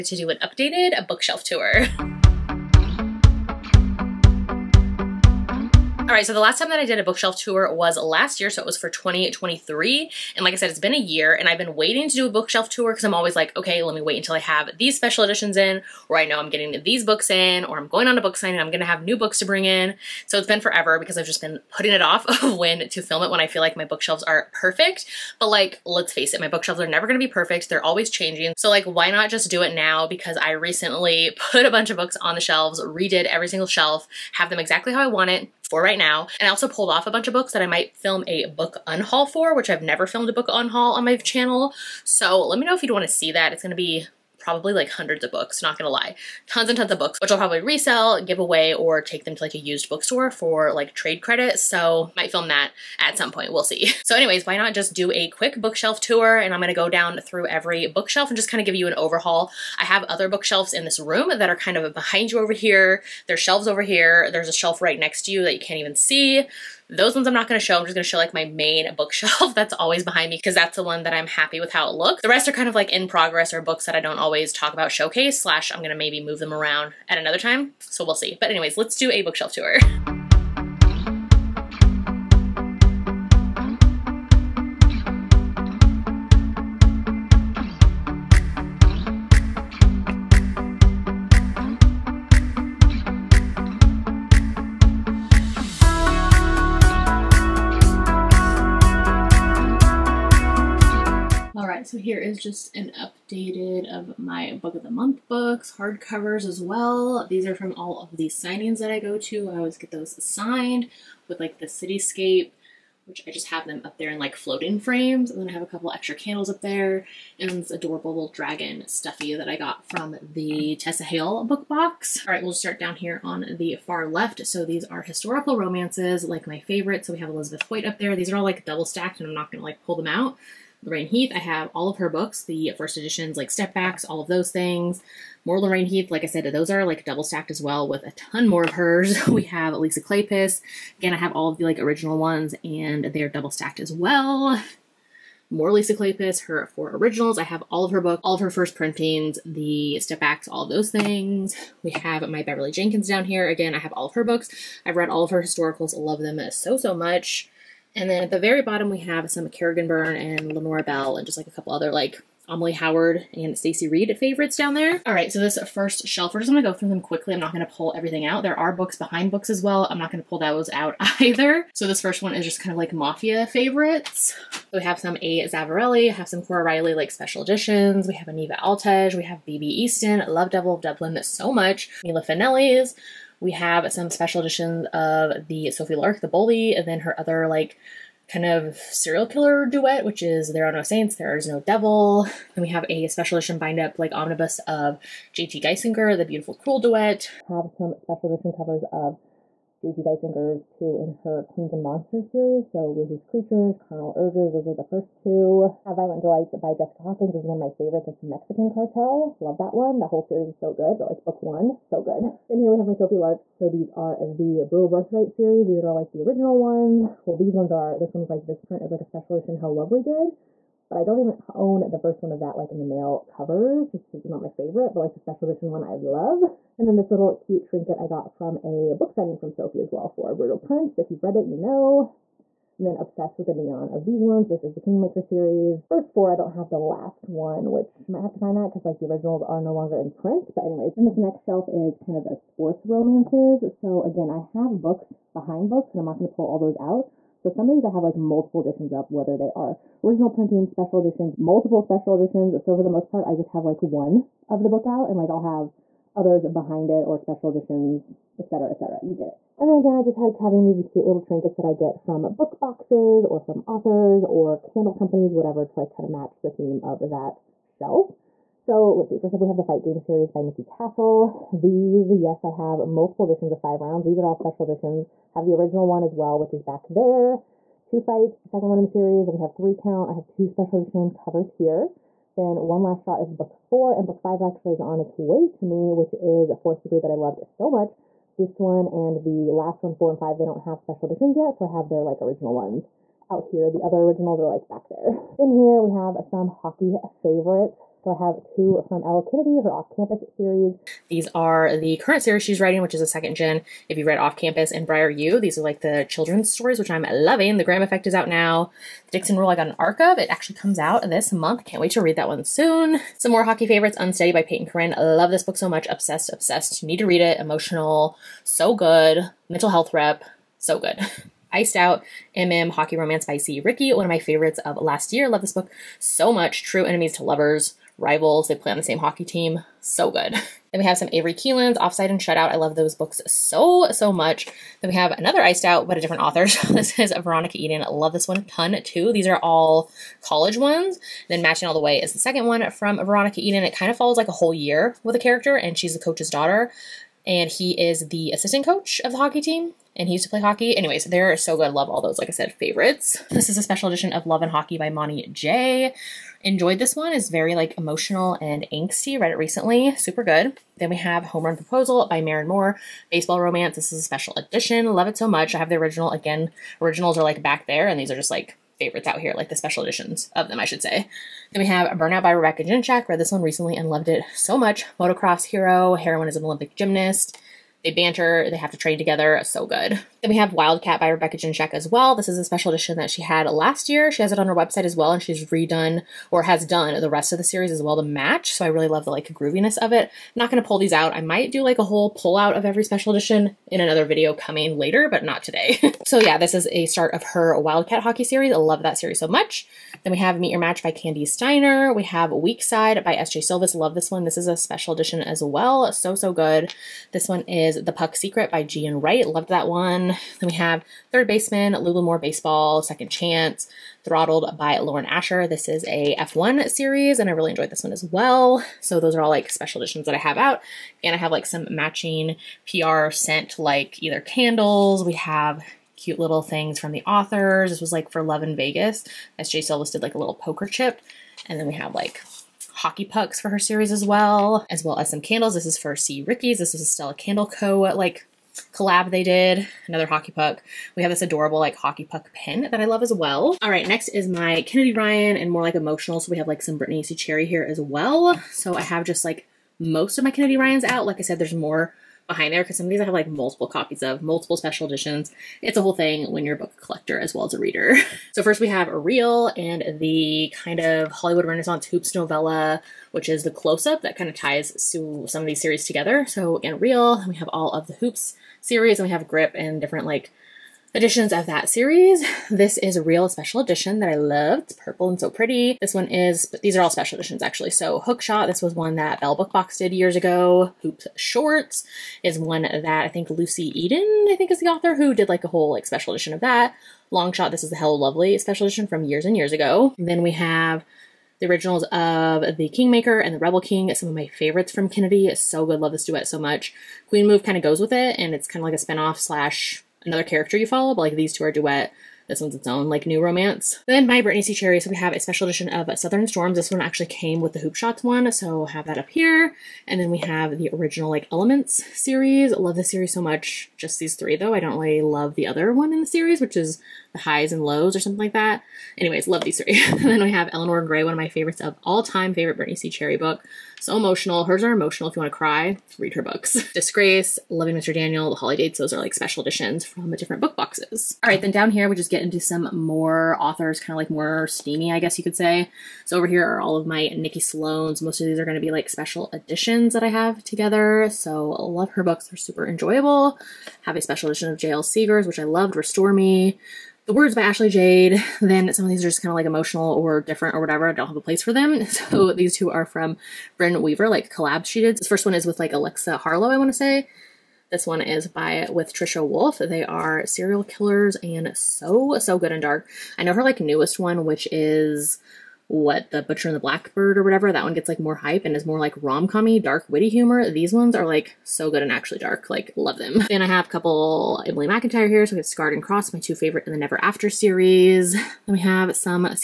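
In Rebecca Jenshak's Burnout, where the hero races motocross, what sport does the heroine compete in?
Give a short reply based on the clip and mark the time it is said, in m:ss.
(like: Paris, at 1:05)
Olympic gymnast, at 6:16.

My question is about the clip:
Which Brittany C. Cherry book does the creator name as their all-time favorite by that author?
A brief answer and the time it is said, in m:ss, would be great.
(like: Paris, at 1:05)
Eleanor Gray, at 8:40.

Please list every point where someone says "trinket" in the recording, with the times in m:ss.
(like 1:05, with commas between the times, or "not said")
3:47, 4:21.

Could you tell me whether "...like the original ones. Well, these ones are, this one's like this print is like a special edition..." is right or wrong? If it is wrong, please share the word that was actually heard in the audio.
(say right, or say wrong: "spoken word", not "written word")
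right.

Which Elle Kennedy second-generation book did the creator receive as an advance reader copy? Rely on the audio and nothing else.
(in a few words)
The Dixon Rule.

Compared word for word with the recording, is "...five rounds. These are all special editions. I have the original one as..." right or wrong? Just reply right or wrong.
right.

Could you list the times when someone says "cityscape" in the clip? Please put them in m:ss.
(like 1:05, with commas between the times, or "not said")
1:51.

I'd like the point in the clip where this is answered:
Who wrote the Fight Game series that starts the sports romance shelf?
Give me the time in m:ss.
4:30.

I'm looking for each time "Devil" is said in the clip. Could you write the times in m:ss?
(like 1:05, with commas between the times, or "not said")
3:00, 3:11.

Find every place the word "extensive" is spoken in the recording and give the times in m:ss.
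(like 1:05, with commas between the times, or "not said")
not said.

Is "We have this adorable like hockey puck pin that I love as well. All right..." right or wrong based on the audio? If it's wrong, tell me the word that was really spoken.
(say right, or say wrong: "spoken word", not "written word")
right.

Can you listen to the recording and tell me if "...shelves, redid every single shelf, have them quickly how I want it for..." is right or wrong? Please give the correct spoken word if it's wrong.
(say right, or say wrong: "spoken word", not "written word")
wrong: "exactly", not "quickly".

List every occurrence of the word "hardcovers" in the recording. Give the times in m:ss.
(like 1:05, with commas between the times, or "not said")
1:45.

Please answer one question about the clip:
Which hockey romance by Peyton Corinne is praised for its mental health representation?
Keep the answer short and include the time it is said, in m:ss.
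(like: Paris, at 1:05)
Unsteady, at 5:13.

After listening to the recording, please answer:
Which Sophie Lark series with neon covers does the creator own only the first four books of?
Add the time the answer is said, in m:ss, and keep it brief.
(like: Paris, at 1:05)
Kingmaker series, at 3:54.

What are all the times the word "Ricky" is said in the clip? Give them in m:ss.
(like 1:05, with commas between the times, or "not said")
5:23, 7:16.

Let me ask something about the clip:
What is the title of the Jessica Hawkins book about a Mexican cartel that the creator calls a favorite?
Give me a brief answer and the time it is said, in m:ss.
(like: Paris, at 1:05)
Violent Delights, at 3:25.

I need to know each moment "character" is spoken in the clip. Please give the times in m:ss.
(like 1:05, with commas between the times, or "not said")
5:45, 8:20.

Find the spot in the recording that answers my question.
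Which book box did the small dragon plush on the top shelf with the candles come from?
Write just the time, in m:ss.
2:00.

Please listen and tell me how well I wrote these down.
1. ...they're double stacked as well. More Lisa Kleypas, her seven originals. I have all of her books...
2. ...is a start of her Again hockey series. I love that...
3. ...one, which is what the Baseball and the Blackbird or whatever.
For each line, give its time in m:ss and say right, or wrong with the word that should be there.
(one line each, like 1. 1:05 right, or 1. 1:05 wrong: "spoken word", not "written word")
1. 2:23 wrong: "four", not "seven"
2. 6:36 wrong: "Wildcat", not "Again"
3. 9:23 wrong: "Butcher", not "Baseball".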